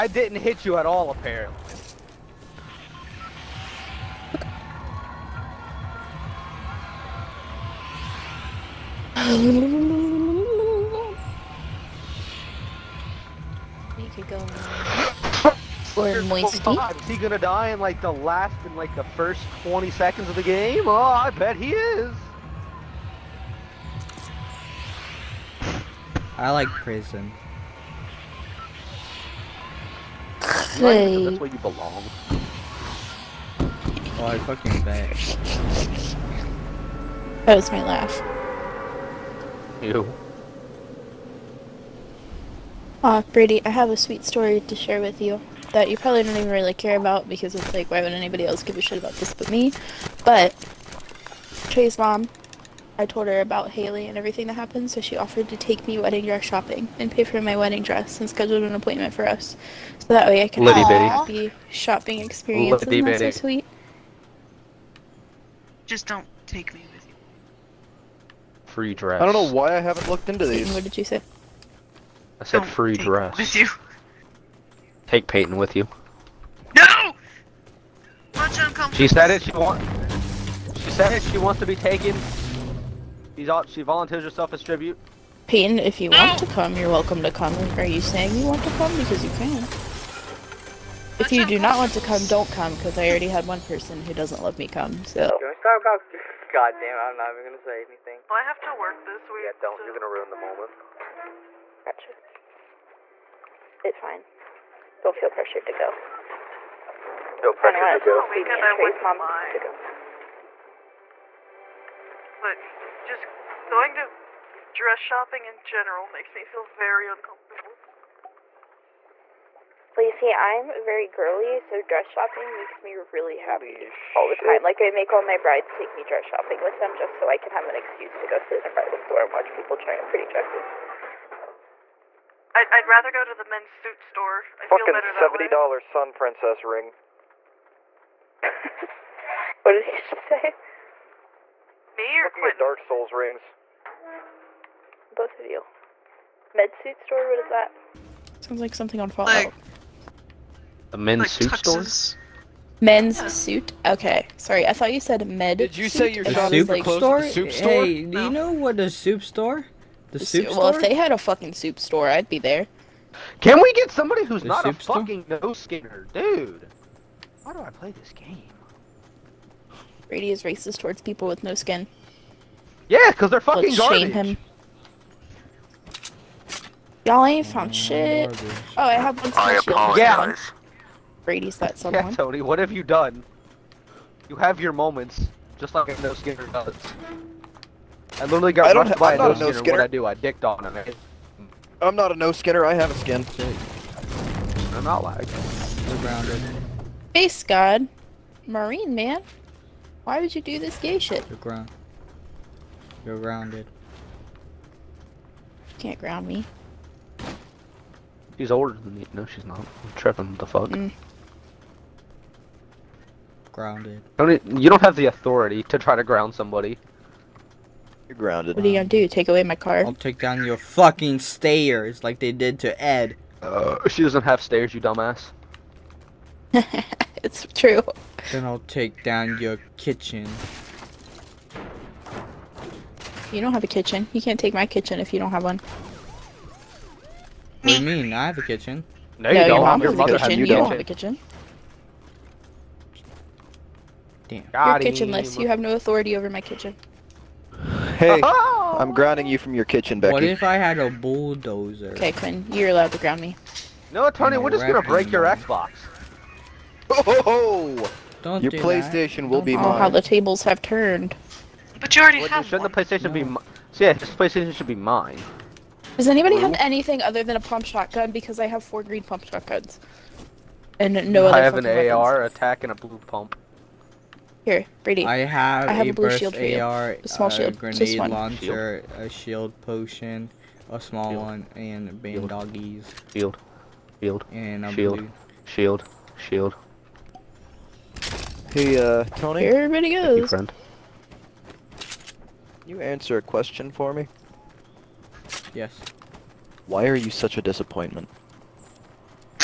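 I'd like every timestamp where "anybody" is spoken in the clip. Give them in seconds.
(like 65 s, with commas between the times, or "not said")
48 s, 266 s.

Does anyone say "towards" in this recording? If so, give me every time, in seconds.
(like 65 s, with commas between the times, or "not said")
170 s.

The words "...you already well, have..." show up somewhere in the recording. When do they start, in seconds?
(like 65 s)
261 s.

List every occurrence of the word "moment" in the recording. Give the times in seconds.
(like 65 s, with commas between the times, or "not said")
100 s, 184 s.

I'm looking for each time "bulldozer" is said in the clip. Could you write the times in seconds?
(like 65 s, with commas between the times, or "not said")
250 s.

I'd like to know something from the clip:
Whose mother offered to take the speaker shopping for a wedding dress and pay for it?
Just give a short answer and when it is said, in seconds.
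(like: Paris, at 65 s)
Trey, at 51 s.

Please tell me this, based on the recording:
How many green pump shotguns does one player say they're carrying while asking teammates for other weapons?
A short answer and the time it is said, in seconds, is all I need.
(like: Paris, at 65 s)
4, at 268 s.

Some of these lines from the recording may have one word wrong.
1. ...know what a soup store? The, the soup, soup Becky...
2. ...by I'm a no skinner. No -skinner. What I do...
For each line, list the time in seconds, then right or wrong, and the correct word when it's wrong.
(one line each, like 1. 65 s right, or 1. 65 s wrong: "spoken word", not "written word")
1. 158 s wrong: "Well", not "Becky"
2. 188 s right.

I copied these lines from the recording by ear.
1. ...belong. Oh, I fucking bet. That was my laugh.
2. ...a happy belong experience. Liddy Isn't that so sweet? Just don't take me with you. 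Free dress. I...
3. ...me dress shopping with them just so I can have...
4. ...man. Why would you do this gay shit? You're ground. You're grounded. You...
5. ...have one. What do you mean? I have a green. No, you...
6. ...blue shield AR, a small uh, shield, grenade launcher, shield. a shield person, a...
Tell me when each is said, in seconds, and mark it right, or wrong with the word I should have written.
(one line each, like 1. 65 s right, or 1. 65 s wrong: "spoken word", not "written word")
1. 31 s right
2. 60 s wrong: "shopping", not "belong"
3. 125 s right
4. 198 s right
5. 235 s wrong: "kitchen", not "green"
6. 275 s wrong: "potion", not "person".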